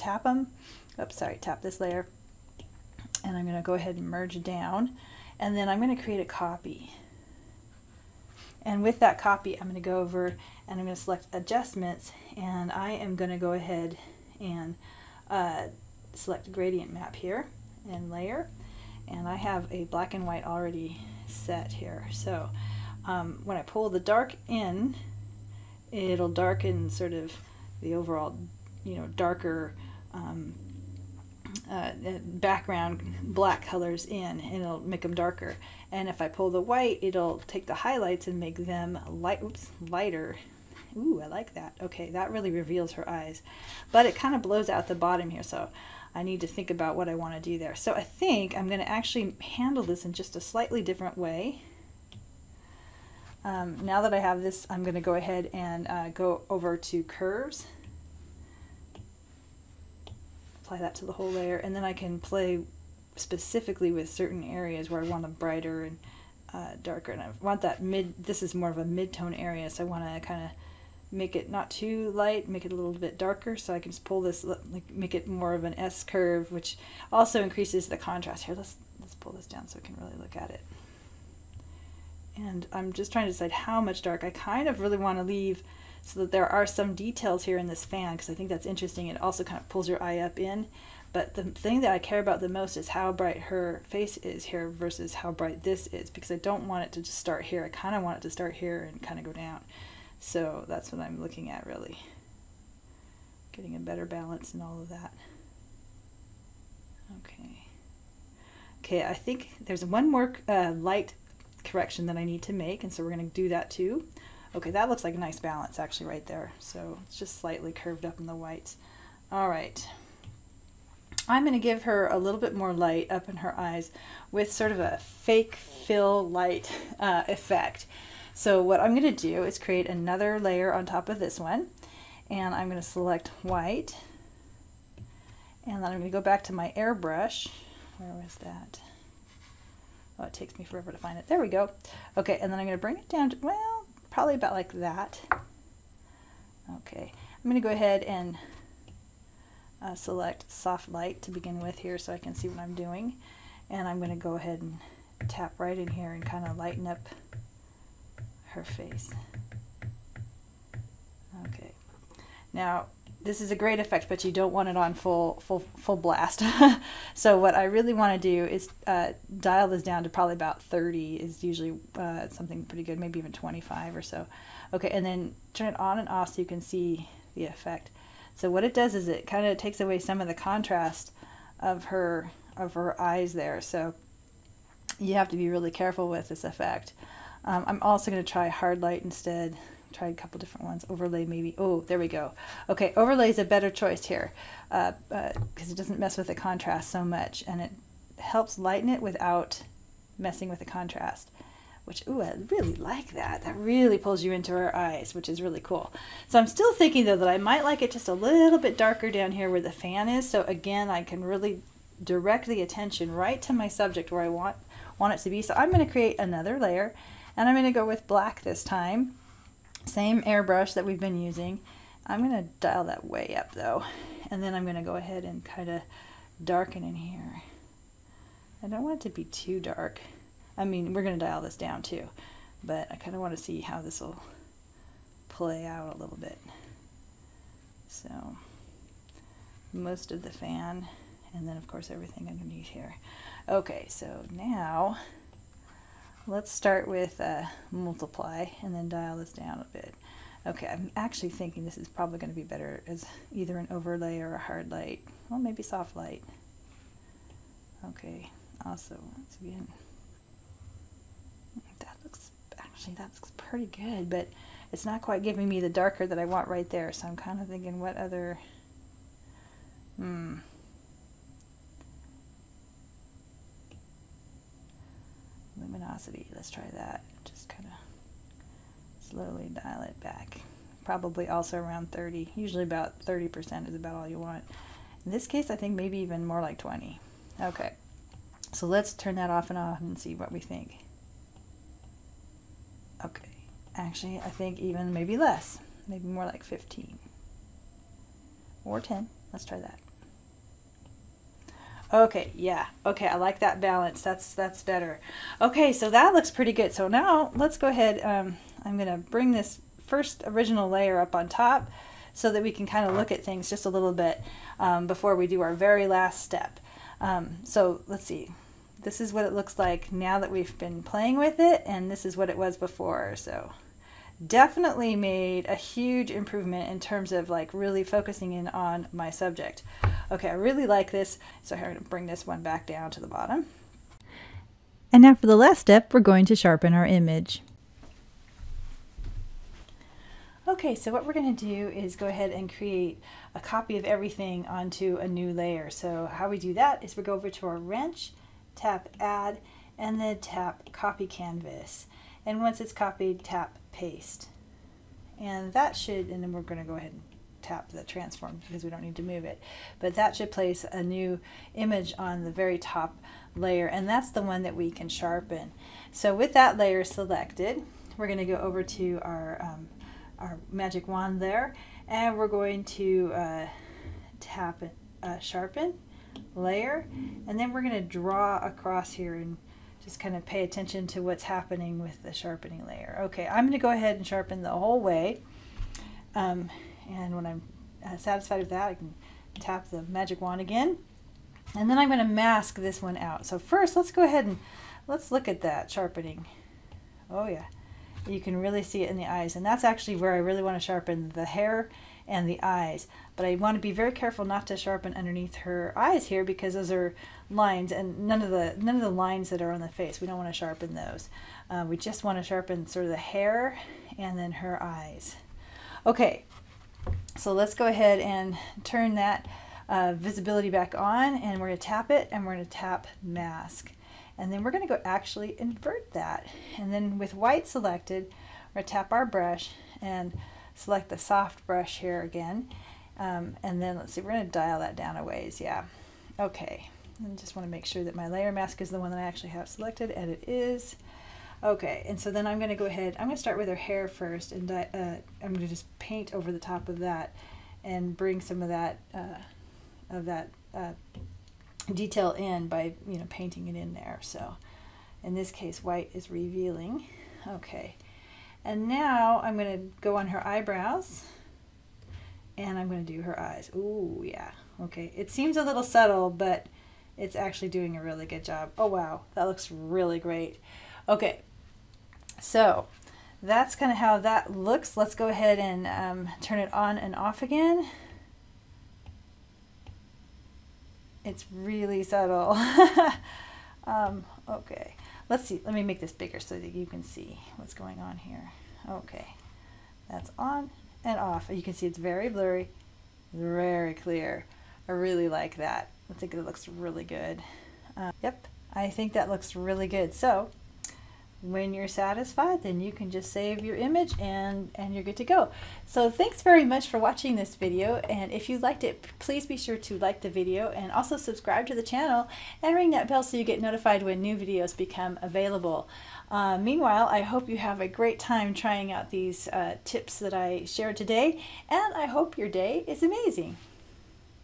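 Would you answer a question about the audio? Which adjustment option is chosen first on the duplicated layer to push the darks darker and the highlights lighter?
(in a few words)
Gradient map.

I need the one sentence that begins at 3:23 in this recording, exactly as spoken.
That really pulls you into our eyes, which is really cool.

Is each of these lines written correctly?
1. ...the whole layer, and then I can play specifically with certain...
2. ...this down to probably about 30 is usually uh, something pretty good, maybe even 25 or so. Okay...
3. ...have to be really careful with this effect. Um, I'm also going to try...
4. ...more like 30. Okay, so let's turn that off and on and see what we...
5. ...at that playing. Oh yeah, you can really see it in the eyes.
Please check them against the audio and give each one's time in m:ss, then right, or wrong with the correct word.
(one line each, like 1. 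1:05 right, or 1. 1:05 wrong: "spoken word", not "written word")
1. 1:01 right
2. 2:49 right
3. 3:05 right
4. 4:46 wrong: "20", not "30"
5. 6:35 wrong: "sharpening", not "playing".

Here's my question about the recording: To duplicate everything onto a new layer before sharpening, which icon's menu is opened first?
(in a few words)
Wrench.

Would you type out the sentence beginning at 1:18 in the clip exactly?
Here, let's, let's pull this down so we can really look at it.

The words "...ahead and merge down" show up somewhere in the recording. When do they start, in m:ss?
0:03.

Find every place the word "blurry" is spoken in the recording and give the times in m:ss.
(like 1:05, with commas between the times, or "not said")
8:12.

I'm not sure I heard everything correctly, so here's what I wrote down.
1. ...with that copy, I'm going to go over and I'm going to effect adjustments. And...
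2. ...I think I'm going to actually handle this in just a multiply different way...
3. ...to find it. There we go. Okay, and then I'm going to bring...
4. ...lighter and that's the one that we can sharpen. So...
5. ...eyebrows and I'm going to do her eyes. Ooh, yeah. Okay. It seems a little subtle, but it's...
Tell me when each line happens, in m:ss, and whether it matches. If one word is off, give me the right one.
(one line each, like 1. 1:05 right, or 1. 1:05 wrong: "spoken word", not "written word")
1. 0:08 wrong: "select", not "effect"
2. 0:47 wrong: "slightly", not "multiply"
3. 2:20 right
4. 6:03 wrong: "layer", not "lighter"
5. 7:40 right.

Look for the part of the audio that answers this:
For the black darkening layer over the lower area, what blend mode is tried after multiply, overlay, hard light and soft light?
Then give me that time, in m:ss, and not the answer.
4:35.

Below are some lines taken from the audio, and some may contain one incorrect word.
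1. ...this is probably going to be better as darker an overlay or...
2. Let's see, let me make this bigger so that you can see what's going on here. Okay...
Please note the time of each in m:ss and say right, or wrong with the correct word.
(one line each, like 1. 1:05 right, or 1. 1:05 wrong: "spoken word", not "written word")
1. 4:11 wrong: "either", not "darker"
2. 8:05 right.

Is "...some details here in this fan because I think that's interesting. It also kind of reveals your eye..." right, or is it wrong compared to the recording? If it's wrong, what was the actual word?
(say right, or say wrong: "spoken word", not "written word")
wrong: "pulls", not "reveals".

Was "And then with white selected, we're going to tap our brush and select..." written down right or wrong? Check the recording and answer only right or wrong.
right.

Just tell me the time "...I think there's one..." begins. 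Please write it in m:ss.
1:49.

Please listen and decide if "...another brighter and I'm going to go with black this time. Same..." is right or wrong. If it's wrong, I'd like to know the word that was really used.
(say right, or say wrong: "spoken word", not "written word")
wrong: "layer", not "brighter".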